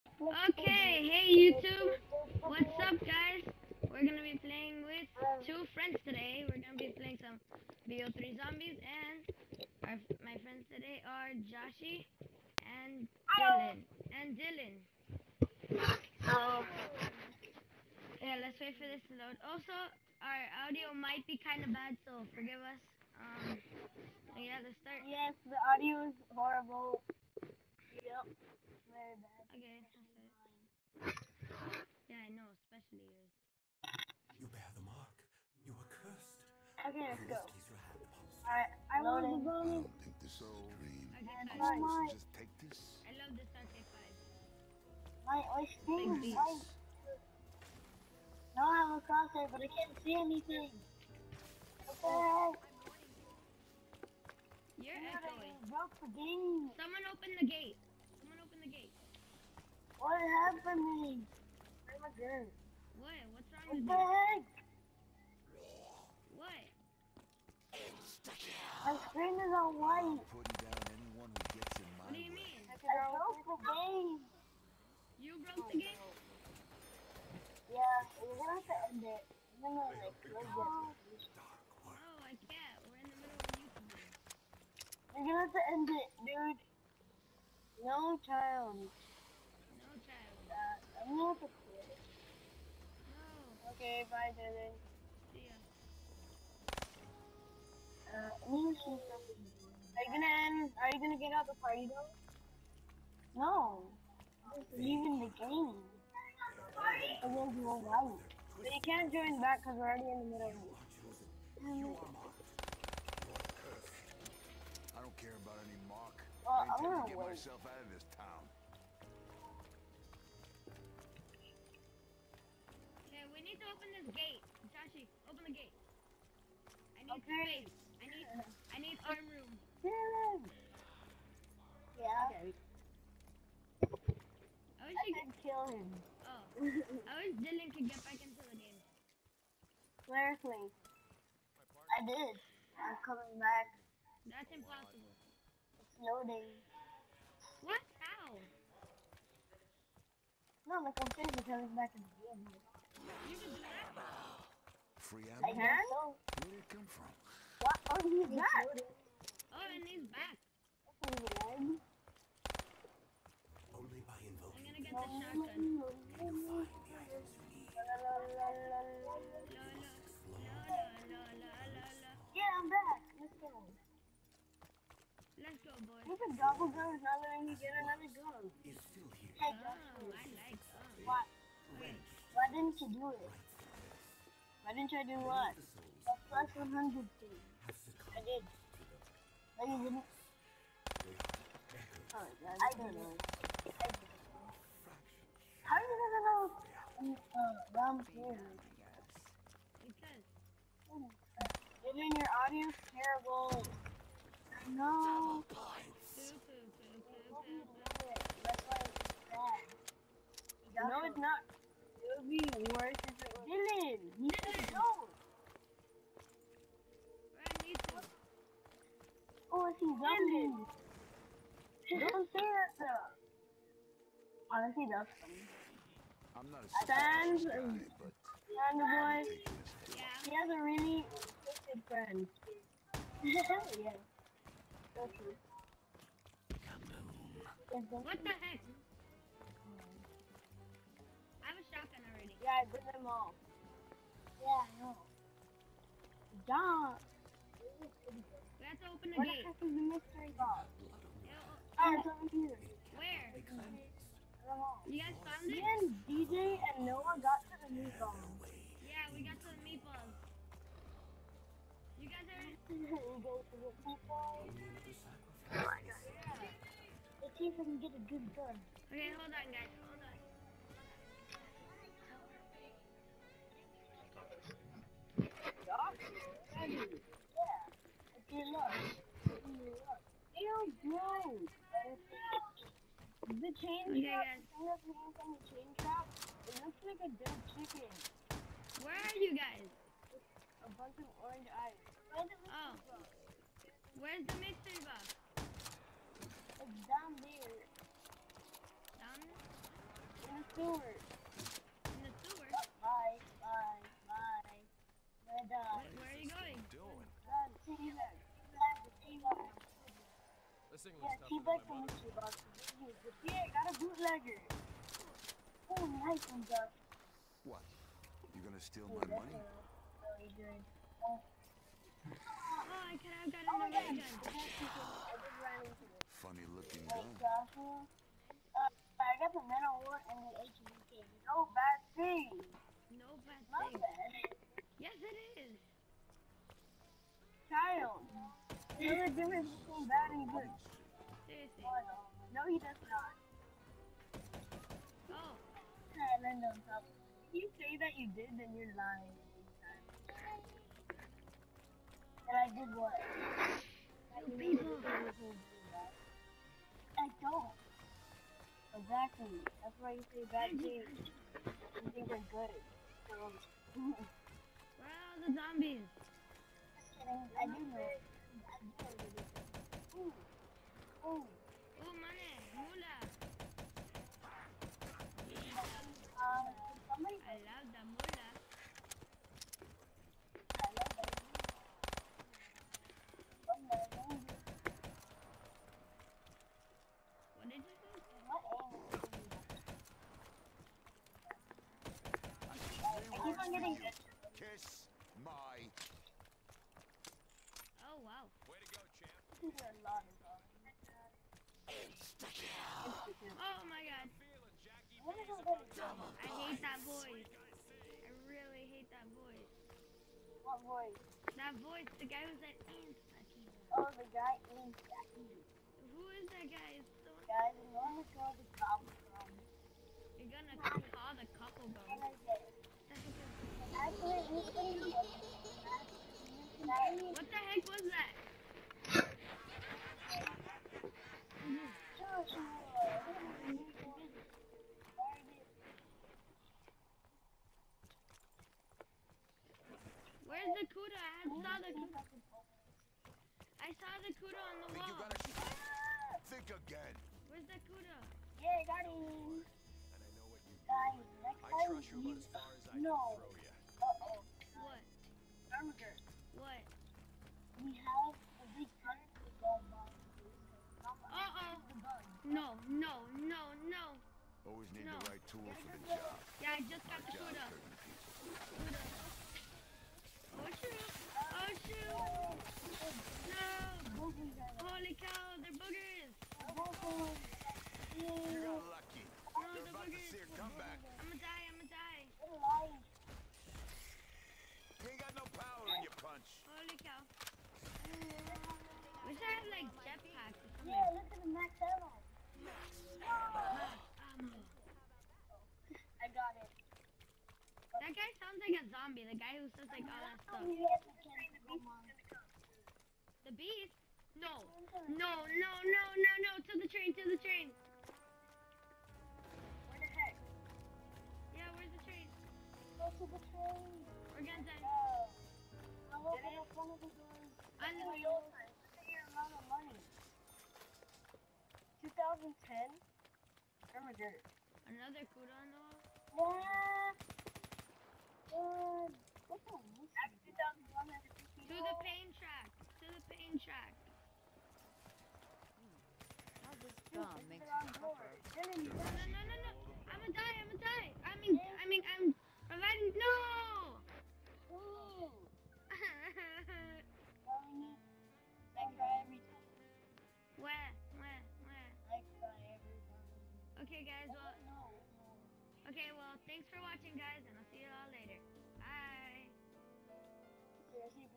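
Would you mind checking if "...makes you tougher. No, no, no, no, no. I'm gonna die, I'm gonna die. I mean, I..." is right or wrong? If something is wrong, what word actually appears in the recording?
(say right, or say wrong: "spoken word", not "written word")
right.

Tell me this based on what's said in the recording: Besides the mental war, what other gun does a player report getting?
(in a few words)
HVK.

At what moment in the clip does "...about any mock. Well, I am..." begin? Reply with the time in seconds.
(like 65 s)
115 s.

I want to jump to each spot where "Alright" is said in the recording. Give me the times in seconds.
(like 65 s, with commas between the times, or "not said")
38 s, 345 s.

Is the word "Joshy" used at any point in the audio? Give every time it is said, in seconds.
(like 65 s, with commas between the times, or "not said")
11 s, 124 s.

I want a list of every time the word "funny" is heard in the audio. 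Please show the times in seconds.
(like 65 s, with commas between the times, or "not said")
225 s, 326 s.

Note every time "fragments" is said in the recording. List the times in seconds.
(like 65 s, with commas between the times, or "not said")
not said.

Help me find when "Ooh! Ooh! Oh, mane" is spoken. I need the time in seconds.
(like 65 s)
368 s.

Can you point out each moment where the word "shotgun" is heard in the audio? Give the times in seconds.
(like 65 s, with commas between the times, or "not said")
164 s.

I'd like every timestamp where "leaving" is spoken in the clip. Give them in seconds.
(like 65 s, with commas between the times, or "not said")
104 s.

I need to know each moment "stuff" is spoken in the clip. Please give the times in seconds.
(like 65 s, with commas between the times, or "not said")
311 s, 500 s.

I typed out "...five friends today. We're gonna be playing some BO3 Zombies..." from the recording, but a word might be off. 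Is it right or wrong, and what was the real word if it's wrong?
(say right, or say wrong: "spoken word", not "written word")
wrong: "two", not "five".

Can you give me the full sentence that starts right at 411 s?
That voice, the guy was at Insta-kill.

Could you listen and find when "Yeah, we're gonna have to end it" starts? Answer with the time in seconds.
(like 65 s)
77 s.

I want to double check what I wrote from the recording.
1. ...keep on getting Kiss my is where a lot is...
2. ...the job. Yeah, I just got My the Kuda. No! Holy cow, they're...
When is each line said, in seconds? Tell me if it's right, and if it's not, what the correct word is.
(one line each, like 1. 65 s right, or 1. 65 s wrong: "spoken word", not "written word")
1. 393 s right
2. 465 s right.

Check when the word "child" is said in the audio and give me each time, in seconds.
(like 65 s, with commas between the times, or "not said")
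88 s, 337 s.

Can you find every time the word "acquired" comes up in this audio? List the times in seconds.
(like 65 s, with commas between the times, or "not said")
not said.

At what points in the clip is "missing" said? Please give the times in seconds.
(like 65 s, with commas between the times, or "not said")
310 s.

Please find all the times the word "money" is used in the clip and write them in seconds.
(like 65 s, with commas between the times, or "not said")
319 s, 519 s.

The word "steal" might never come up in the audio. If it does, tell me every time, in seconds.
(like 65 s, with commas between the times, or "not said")
318 s.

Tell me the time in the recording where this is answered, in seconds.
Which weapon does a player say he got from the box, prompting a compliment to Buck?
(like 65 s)
313 s.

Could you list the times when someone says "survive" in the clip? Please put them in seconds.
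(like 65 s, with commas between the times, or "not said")
not said.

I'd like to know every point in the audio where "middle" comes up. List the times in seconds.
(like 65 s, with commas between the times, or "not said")
83 s, 110 s.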